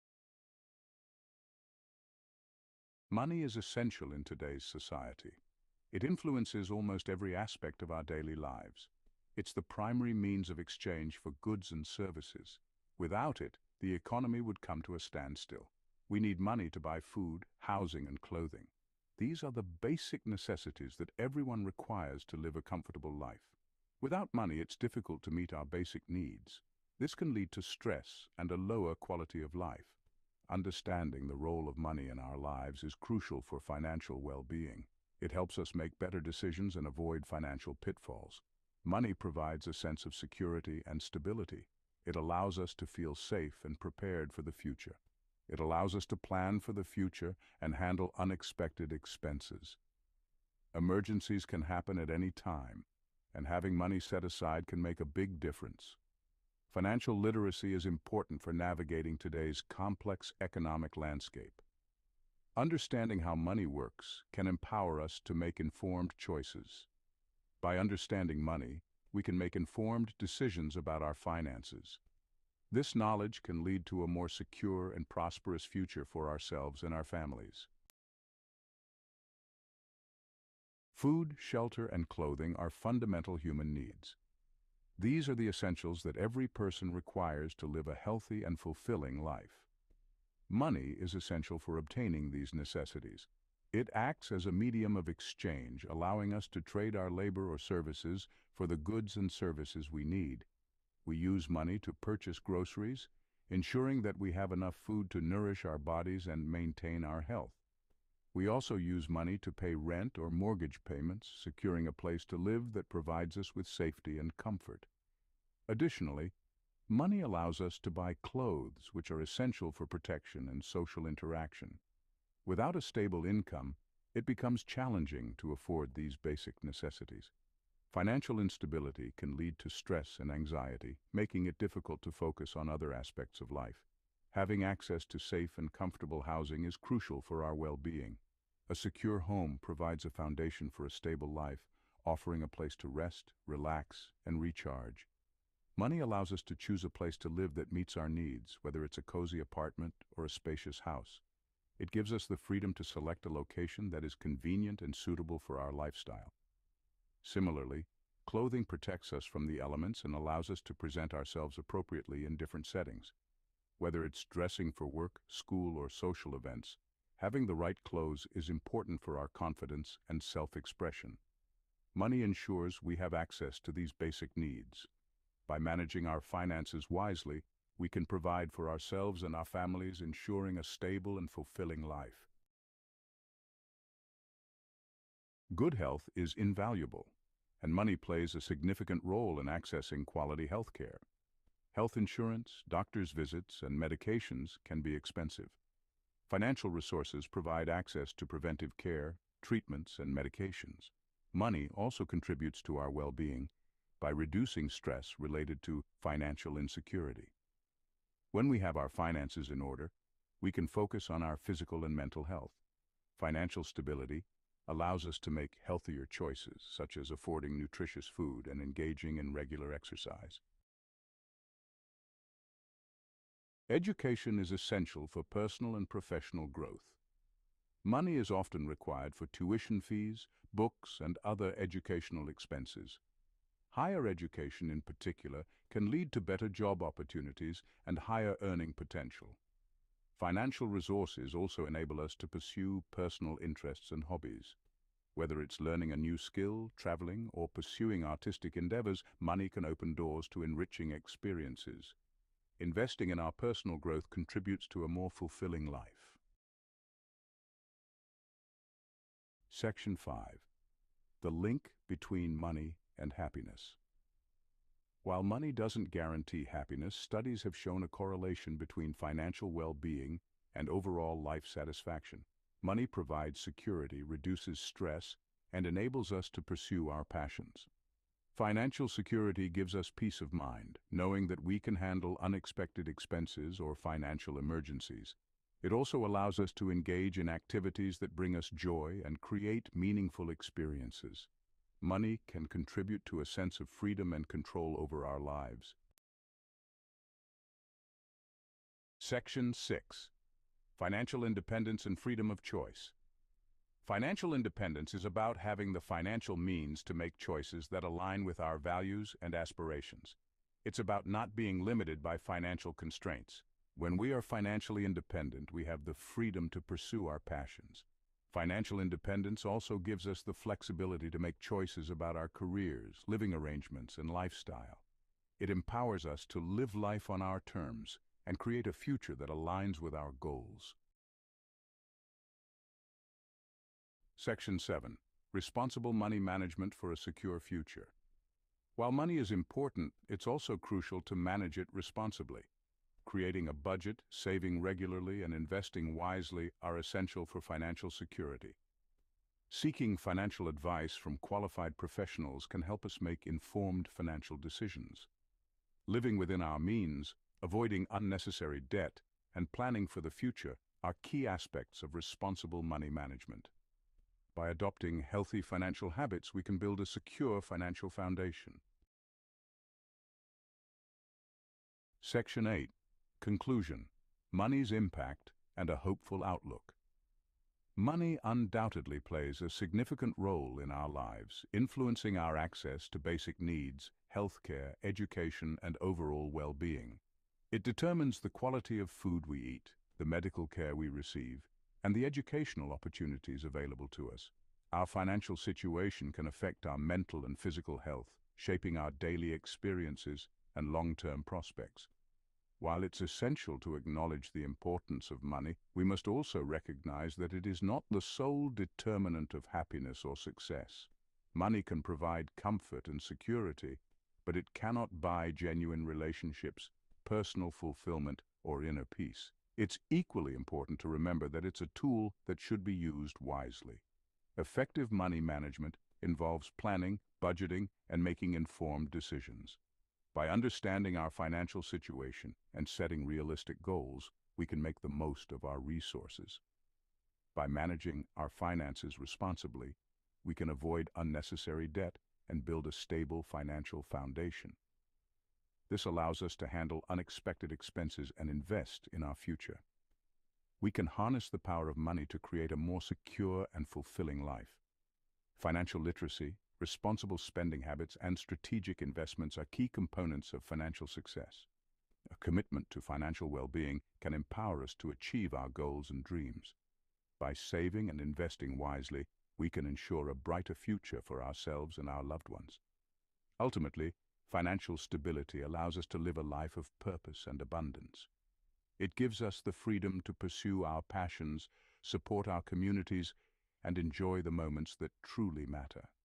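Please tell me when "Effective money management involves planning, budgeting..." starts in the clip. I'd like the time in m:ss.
7:04.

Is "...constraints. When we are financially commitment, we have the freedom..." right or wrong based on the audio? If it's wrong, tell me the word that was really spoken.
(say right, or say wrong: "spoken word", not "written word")
wrong: "independent", not "commitment".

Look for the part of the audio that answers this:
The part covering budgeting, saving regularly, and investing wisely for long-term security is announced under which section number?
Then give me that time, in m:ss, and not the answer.
5:34.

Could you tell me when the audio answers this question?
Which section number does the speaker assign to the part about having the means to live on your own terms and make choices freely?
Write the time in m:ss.
4:58.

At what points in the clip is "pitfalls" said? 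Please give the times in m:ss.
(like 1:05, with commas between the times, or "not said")
0:37.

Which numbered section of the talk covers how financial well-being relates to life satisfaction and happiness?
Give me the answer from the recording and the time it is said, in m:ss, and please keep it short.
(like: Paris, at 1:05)
5, at 4:19.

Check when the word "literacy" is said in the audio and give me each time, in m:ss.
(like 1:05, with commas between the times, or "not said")
0:57, 7:35.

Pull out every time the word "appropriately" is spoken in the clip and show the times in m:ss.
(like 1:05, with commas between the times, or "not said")
2:41.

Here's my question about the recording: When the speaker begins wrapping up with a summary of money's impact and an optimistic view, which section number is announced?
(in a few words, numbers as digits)
8.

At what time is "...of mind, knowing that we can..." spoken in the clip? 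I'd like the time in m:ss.
4:40.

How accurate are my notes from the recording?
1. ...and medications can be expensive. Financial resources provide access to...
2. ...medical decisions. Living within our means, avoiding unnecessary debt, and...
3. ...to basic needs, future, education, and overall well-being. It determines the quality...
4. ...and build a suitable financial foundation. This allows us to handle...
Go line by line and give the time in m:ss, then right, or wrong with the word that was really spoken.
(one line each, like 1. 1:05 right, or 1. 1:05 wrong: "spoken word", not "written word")
1. 3:13 right
2. 5:53 wrong: "financial", not "medical"
3. 6:22 wrong: "healthcare", not "future"
4. 7:22 wrong: "stable", not "suitable".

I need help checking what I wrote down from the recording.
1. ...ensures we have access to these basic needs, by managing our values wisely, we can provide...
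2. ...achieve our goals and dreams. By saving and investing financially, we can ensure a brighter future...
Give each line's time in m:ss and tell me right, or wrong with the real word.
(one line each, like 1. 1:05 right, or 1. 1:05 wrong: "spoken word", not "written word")
1. 2:52 wrong: "finances", not "values"
2. 7:44 wrong: "wisely", not "financially".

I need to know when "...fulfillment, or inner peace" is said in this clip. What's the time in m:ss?
6:57.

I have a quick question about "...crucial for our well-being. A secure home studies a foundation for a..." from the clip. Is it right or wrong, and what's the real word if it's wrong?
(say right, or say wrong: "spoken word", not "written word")
wrong: "provides", not "studies".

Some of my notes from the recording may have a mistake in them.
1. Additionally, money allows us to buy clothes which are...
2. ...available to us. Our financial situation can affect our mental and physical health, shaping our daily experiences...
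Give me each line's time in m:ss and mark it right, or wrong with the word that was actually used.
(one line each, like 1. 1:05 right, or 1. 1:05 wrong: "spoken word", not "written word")
1. 1:55 right
2. 6:33 right.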